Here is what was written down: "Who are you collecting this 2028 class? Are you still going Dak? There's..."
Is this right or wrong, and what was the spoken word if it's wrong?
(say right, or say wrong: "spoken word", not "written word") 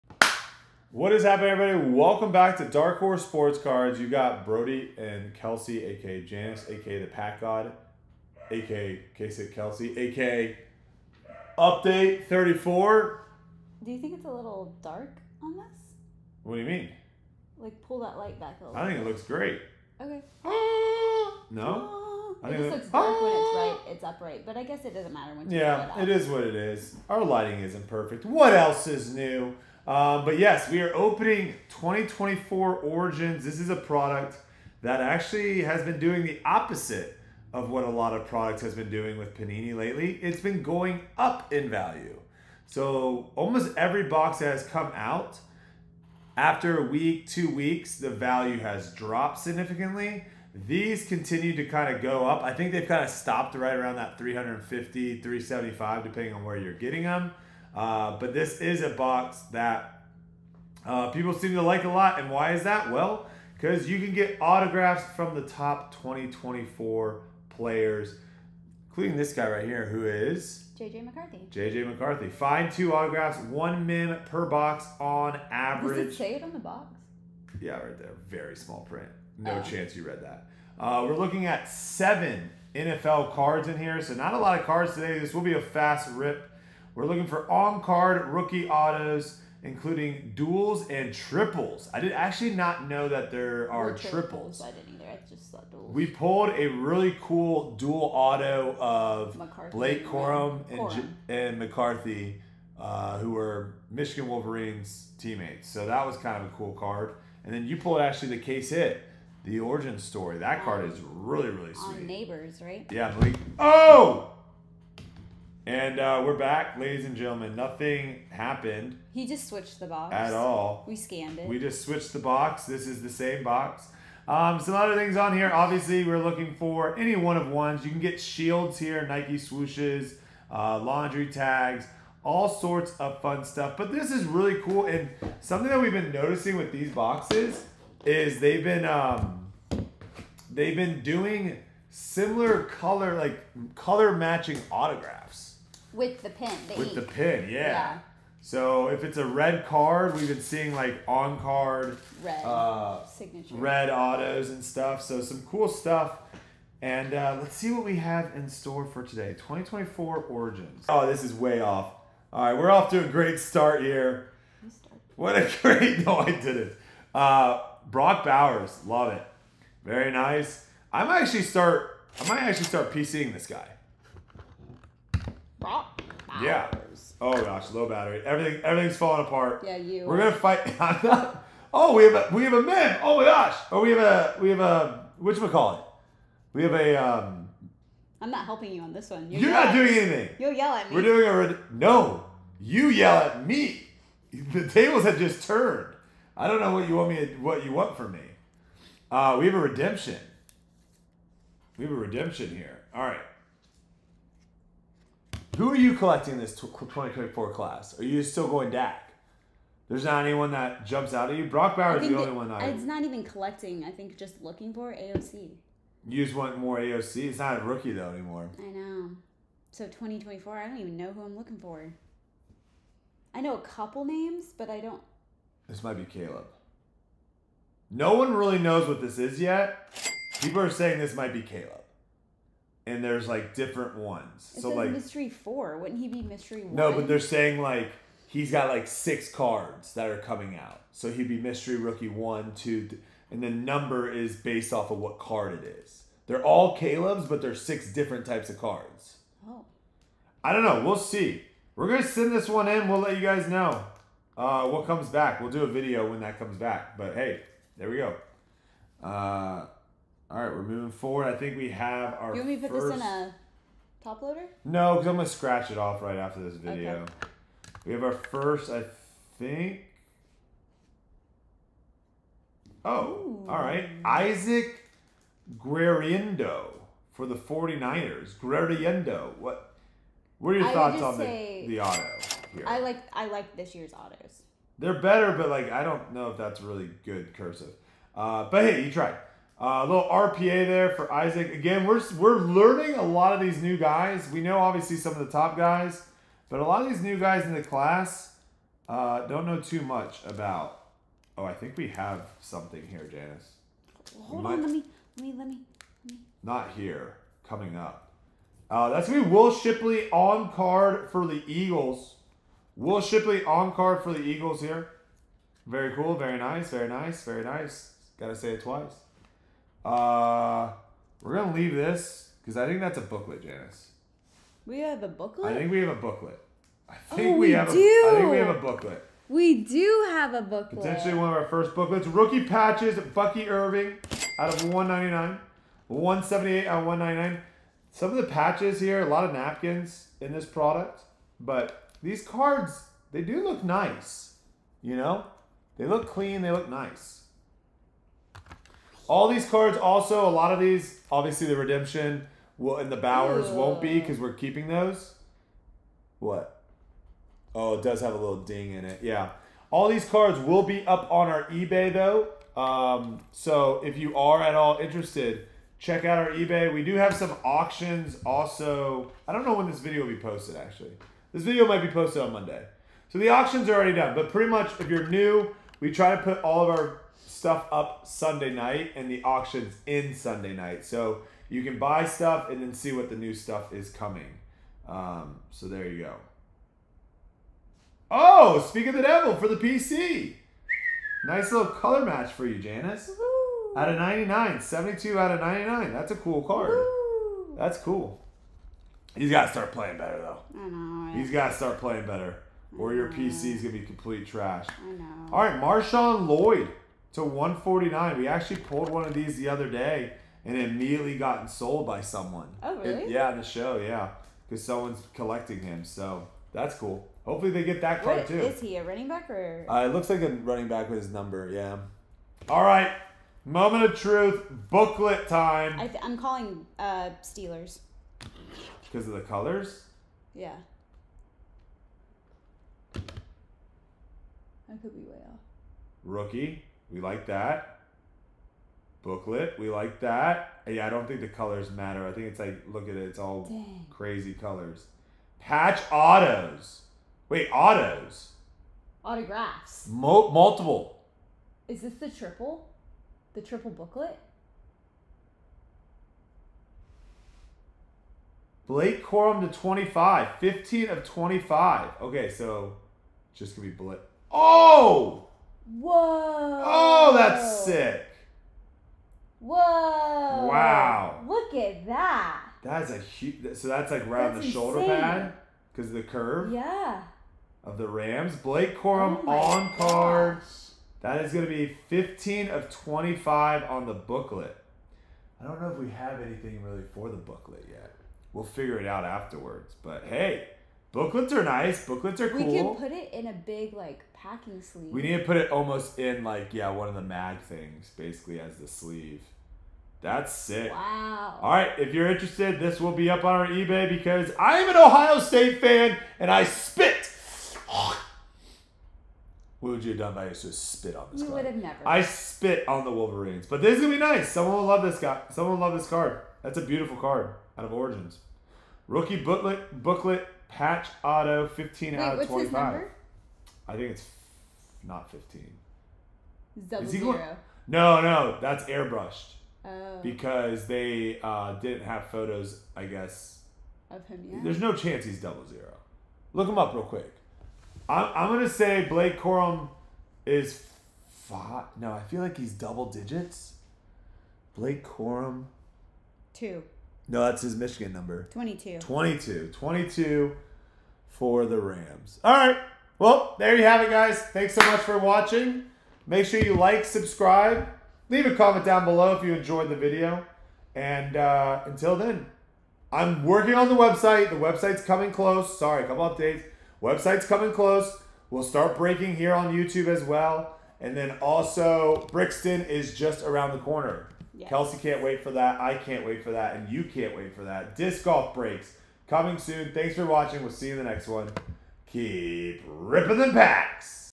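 wrong: "2024", not "2028".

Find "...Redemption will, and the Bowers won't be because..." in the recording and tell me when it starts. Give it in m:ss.
5:51.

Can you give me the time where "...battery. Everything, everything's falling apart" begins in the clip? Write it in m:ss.
2:57.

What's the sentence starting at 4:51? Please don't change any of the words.
Again, we're, we're learning a lot of these new guys.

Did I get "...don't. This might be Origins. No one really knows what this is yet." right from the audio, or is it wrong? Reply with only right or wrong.
wrong.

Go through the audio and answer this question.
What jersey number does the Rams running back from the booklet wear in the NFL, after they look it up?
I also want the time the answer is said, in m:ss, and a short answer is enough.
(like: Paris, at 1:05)
22, at 9:09.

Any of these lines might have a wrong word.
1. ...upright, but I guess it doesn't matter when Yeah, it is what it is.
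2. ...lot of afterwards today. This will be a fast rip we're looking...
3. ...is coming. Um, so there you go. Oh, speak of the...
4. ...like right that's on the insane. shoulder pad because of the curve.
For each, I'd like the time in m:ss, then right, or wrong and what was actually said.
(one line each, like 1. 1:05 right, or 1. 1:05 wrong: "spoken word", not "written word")
1. 0:24 right
2. 1:24 wrong: "cards", not "afterwards"
3. 6:23 right
4. 7:53 right.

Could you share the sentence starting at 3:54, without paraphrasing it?
It so like mystery four, wouldn't he be mystery one?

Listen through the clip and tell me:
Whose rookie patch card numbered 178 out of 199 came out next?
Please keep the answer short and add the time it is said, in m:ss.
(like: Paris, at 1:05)
Bucky Irving, at 5:33.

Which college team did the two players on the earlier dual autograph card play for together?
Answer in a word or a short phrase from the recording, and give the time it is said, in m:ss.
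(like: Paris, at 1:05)
Michigan Wolverines, at 1:43.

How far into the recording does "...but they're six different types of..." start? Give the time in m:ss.
4:07.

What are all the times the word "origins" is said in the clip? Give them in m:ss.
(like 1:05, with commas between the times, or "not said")
0:32, 1:49, 2:40, 8:37.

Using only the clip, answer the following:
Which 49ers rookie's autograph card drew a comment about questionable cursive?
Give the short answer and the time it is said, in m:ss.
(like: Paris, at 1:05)
Isaac Guerendo, at 4:34.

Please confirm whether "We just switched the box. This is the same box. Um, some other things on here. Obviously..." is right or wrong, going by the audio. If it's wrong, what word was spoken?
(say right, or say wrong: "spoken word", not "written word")
right.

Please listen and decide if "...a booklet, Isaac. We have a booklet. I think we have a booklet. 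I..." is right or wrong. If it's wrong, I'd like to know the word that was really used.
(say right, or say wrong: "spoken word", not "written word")
wrong: "Janice", not "Isaac".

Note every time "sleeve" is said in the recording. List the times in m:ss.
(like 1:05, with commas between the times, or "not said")
8:14, 8:18.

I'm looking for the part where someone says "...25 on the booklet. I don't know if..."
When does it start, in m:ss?
8:02.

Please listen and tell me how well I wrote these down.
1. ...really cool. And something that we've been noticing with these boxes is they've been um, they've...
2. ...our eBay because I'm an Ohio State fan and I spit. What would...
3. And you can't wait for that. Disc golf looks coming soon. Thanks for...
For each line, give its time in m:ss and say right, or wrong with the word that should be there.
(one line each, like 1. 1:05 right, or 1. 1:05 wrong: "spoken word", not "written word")
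1. 2:14 right
2. 8:23 right
3. 9:36 wrong: "breaks", not "looks".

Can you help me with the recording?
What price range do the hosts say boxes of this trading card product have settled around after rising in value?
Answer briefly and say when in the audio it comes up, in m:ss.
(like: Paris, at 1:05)
350 to 375, at 0:54.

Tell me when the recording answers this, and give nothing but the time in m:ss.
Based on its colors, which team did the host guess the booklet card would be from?
7:07.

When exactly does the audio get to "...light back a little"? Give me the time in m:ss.
0:18.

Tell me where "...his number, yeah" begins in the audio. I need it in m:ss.
7:00.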